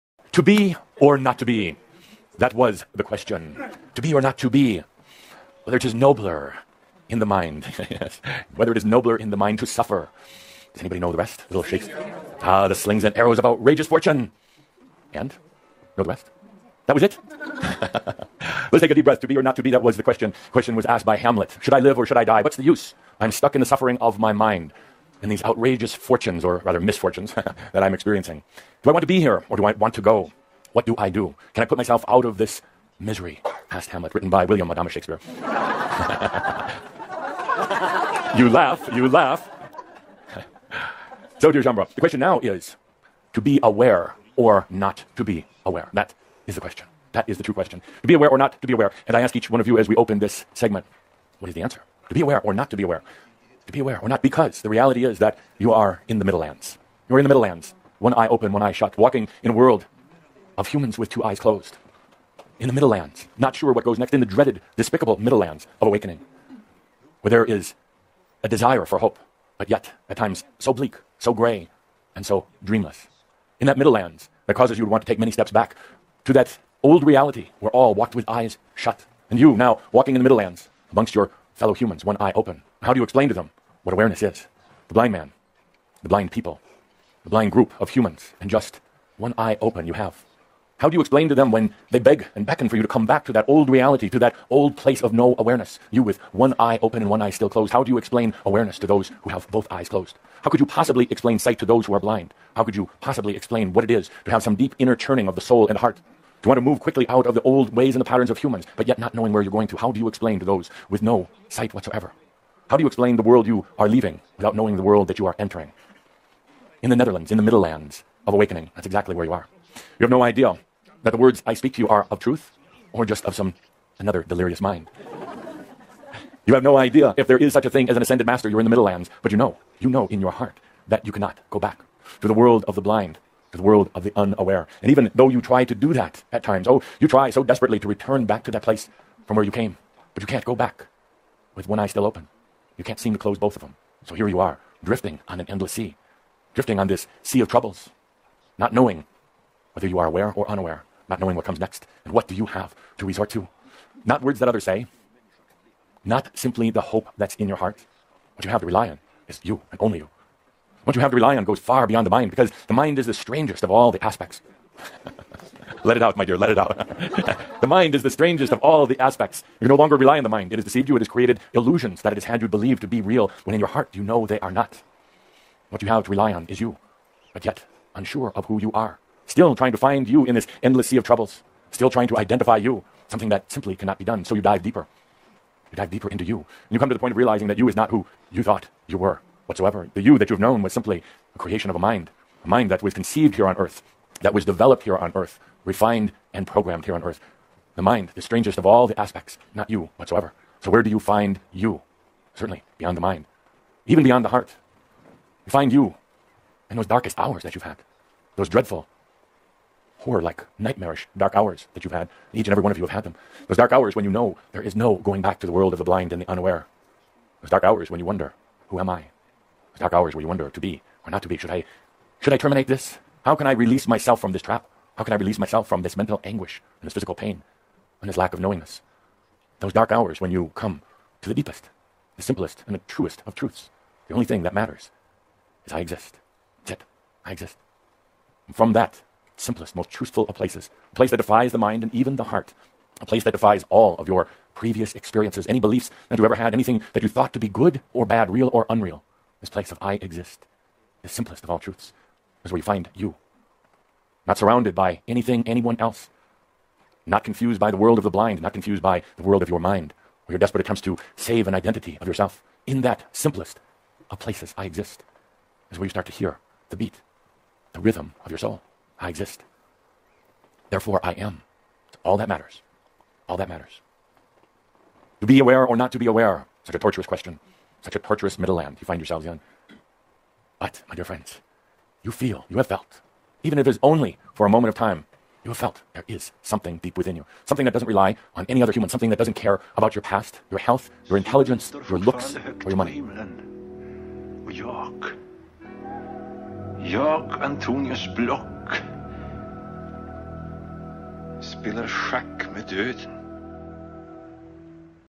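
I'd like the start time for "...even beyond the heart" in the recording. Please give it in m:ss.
3:23.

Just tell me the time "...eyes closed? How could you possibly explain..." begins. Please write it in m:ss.
1:39.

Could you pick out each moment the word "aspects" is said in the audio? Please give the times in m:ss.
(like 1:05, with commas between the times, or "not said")
2:44, 2:48, 3:18.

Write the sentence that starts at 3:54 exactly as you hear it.
The only thing that matters is I exist.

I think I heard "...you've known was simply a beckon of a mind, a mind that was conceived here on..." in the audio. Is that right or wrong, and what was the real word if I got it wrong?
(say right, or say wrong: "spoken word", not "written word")
wrong: "creation", not "beckon".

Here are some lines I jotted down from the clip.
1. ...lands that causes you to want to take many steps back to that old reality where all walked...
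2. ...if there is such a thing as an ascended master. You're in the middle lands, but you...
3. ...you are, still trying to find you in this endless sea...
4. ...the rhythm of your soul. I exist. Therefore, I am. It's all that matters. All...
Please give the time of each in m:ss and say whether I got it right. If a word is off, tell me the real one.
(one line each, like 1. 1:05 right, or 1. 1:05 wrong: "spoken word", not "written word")
1. 1:13 right
2. 2:07 right
3. 2:58 right
4. 4:27 right.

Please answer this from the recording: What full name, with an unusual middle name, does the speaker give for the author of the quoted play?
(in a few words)
William Adamus Shakespeare.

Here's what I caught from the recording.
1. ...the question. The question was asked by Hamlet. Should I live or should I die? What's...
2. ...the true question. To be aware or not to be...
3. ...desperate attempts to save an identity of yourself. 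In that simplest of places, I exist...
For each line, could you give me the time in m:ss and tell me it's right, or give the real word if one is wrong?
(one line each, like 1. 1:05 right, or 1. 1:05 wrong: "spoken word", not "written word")
1. 0:19 right
2. 0:47 right
3. 4:20 right.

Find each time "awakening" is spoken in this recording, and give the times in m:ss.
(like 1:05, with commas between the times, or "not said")
1:05, 1:58.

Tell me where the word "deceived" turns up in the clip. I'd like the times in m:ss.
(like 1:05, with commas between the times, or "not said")
2:50.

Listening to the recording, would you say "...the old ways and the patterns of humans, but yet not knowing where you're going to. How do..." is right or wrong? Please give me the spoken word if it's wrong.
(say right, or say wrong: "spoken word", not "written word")
right.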